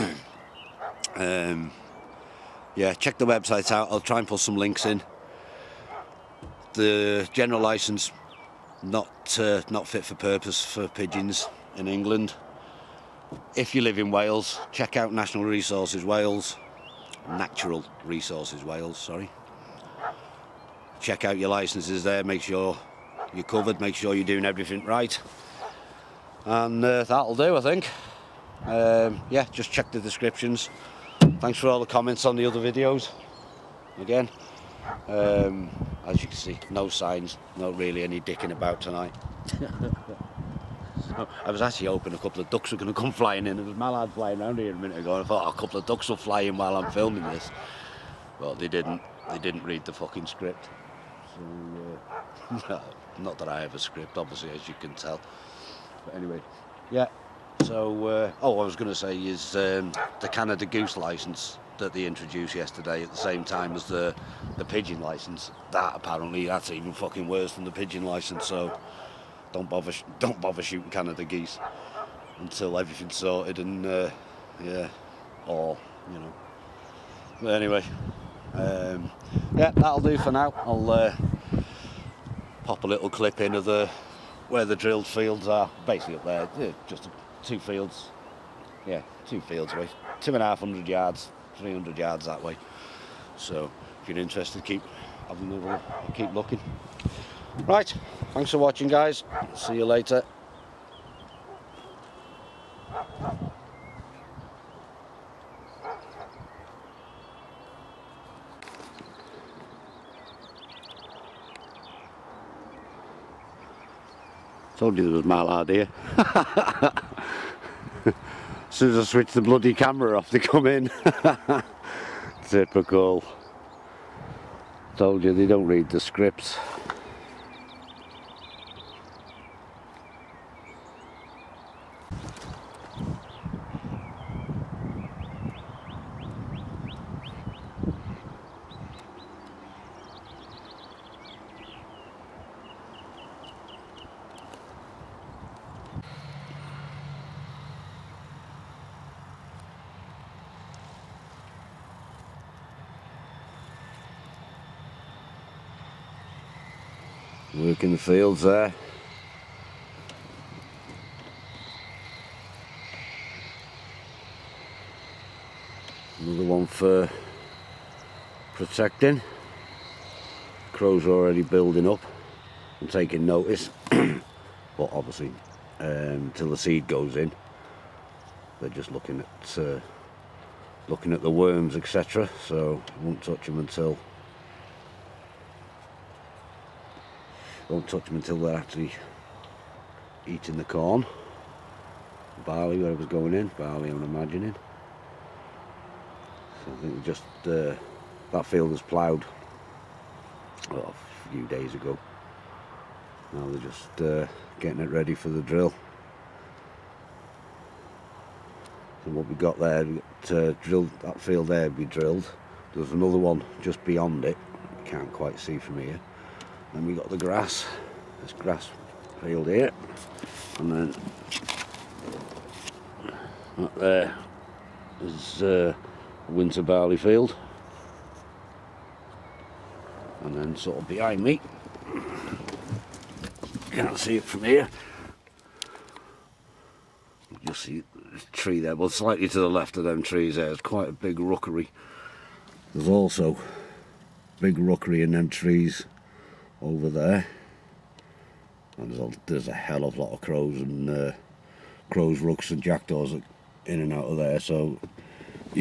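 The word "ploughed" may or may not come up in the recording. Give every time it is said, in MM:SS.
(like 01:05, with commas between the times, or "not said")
03:18.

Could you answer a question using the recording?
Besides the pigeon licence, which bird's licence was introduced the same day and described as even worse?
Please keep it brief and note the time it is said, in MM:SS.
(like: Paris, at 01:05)
Canada Goose, at 01:00.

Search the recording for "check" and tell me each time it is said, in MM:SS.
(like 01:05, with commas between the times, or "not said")
00:02, 00:14, 00:20, 00:29.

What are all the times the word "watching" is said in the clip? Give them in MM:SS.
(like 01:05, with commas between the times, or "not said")
01:38.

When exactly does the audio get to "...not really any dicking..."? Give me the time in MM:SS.
00:37.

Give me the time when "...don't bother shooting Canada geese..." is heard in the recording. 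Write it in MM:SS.
01:10.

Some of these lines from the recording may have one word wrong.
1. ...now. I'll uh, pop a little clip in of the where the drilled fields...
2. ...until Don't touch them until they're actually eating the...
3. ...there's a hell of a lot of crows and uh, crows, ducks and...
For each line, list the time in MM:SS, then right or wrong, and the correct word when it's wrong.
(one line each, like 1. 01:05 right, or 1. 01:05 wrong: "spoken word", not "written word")
1. 01:20 right
2. 03:03 right
3. 04:09 wrong: "rooks", not "ducks".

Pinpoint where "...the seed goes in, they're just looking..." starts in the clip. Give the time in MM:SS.
02:56.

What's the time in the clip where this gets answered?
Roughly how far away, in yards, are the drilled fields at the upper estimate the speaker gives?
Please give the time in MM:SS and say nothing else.
01:31.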